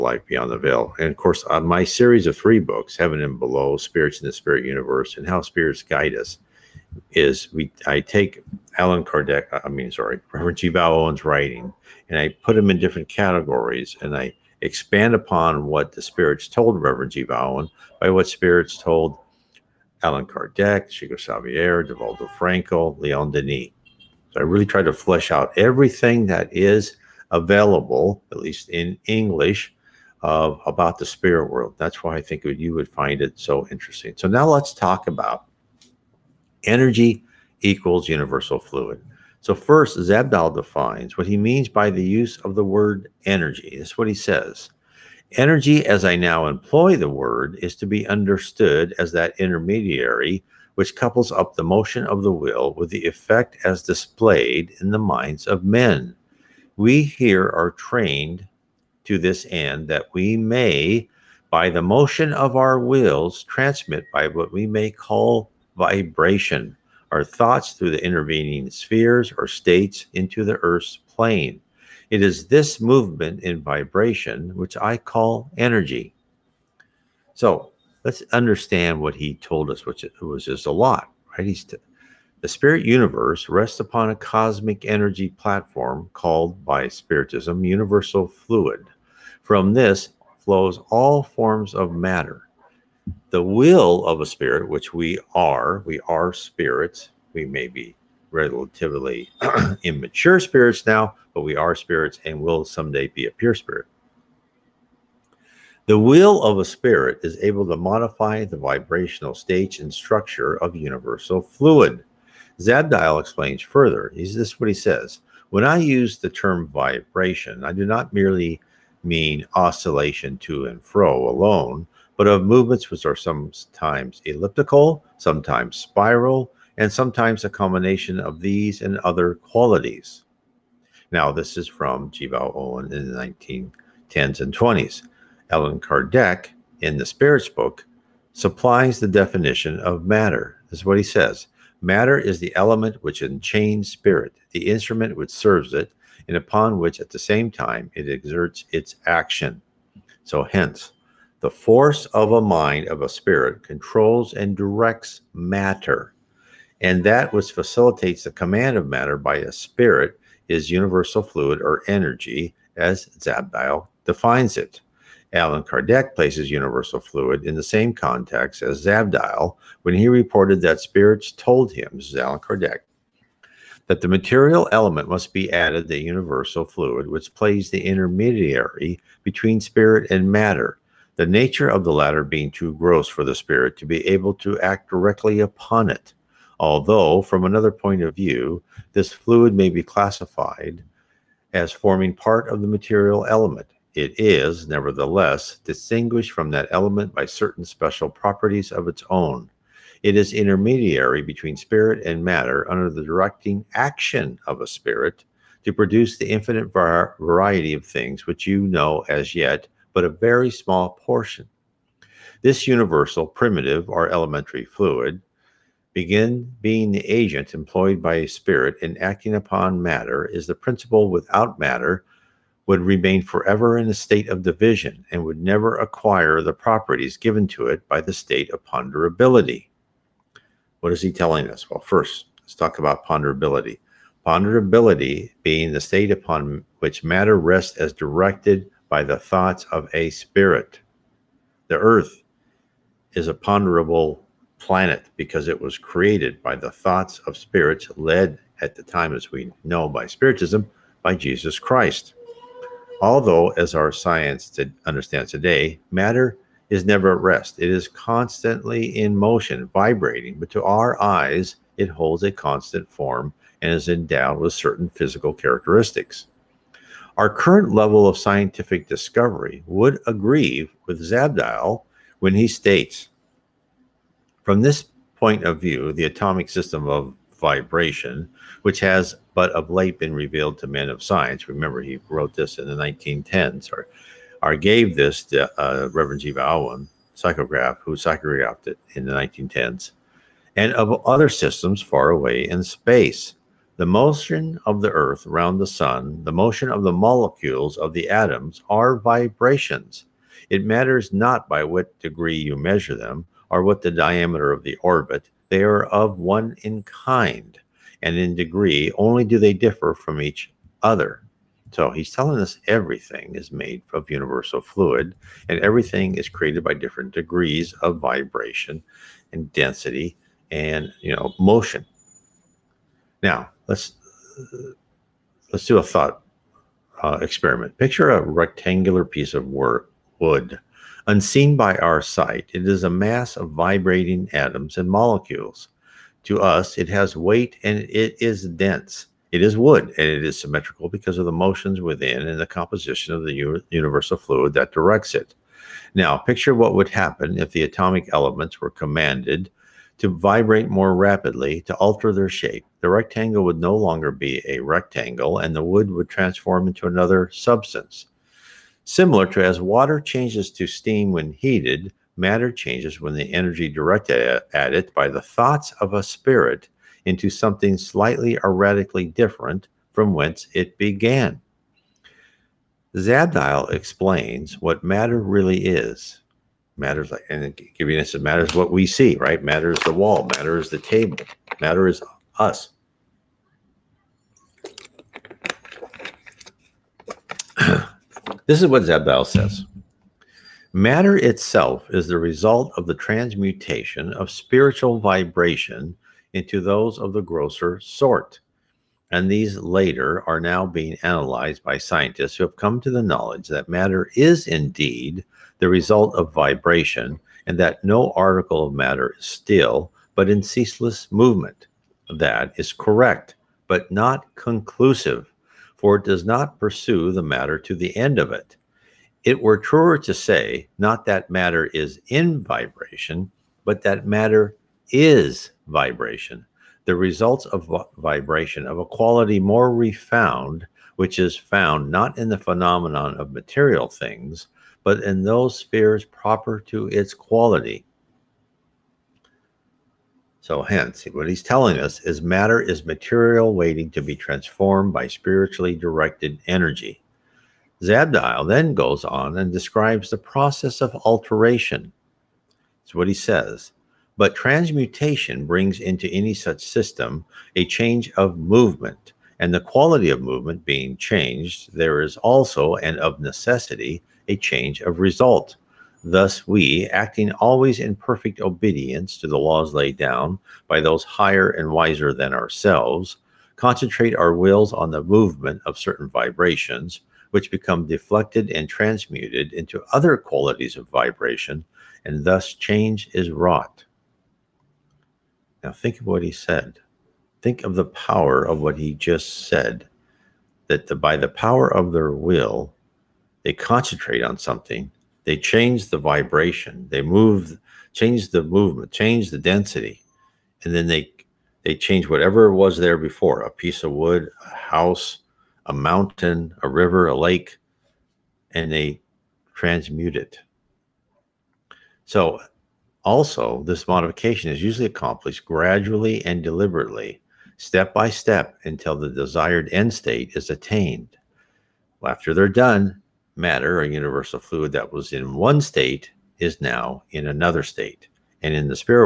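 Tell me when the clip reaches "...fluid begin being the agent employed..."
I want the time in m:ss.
3:34.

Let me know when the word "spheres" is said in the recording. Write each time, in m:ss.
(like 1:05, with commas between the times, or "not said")
1:08, 7:15.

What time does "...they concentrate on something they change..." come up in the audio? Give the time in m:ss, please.
8:13.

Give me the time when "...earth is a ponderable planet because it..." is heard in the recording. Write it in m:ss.
4:01.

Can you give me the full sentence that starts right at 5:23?
Now let's let's do a thought uh, experiment.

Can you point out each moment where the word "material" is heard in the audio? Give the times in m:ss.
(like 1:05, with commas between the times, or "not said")
2:54, 3:12, 7:13, 7:22.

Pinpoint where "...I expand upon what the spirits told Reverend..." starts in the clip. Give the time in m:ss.
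0:14.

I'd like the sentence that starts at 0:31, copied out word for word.
That's why I think you would find it so interesting.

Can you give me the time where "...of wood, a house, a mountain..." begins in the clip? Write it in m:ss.
8:23.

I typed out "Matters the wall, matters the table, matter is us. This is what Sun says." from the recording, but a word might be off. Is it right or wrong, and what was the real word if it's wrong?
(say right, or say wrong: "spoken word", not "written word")
wrong: "Zabdiel", not "Sun".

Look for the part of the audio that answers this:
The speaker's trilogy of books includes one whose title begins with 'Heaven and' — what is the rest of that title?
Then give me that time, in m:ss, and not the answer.
0:02.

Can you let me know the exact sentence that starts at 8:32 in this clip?
So, also, this modification is usually accomplished gradually and deliberately, step by step, until the desired end state is attained.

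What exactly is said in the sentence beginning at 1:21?
He's t- the spirit universe rests upon a cosmic energy platform called by Spiritism universal fluid.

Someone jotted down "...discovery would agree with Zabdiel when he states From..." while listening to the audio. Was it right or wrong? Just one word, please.
right.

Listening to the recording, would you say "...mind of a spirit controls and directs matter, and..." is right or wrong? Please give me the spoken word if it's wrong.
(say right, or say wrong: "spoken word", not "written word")
right.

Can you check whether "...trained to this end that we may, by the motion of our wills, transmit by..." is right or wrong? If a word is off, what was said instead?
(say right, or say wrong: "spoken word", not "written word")
right.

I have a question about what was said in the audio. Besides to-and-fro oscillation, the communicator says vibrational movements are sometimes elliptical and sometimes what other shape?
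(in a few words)
spiral.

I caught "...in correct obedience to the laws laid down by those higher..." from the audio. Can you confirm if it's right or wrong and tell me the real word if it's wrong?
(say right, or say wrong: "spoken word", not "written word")
wrong: "perfect", not "correct".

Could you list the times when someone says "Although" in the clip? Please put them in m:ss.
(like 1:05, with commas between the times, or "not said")
3:06, 4:13.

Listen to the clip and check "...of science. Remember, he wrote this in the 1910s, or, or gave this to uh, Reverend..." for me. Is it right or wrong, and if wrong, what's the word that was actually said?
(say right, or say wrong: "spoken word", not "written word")
right.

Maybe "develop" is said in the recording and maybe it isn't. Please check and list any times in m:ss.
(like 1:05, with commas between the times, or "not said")
not said.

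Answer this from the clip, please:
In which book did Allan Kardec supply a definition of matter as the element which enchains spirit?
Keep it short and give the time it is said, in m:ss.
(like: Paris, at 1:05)
The Spirits Book, at 2:17.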